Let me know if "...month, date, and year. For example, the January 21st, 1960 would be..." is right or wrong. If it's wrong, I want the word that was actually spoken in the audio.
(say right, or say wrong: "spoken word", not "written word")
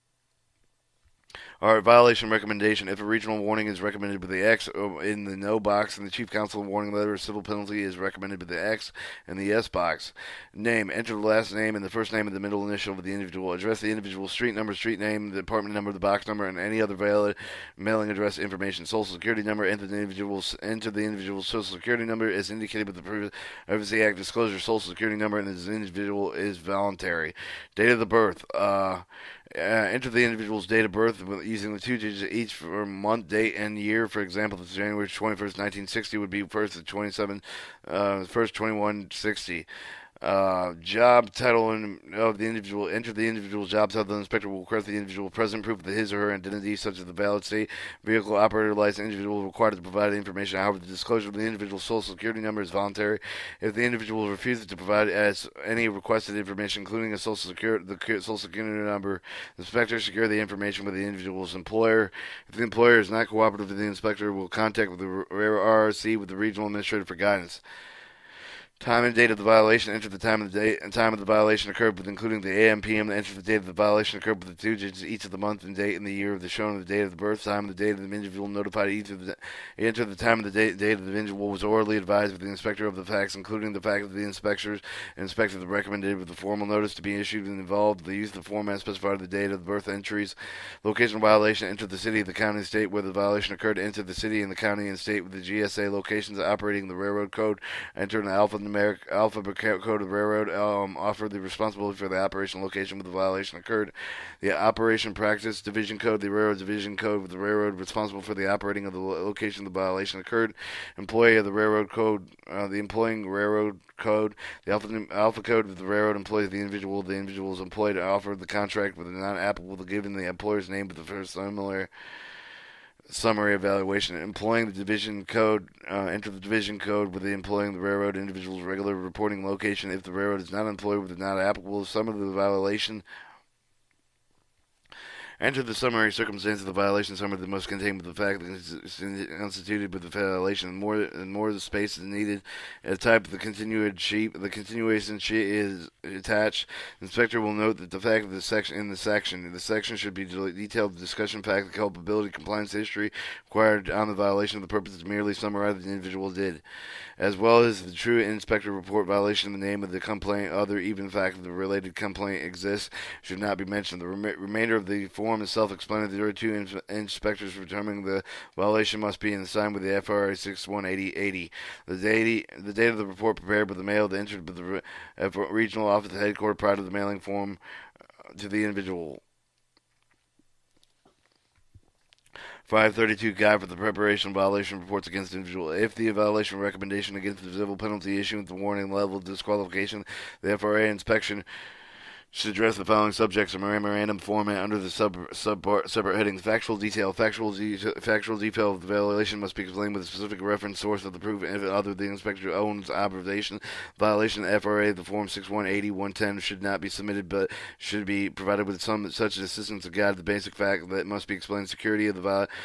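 right.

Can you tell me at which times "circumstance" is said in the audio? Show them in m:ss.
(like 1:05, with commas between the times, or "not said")
2:16.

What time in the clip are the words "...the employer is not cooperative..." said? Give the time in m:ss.
1:02.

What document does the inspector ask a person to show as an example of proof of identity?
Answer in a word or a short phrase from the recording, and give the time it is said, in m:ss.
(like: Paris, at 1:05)
valid state vehicle operator license, at 0:47.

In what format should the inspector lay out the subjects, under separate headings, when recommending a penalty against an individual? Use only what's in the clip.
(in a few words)
memorandum format.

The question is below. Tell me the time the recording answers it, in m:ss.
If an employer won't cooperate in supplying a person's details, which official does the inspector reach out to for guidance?
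1:06.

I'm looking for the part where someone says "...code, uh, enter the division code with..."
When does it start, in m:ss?
2:05.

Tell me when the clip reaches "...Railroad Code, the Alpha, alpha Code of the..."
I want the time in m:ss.
1:53.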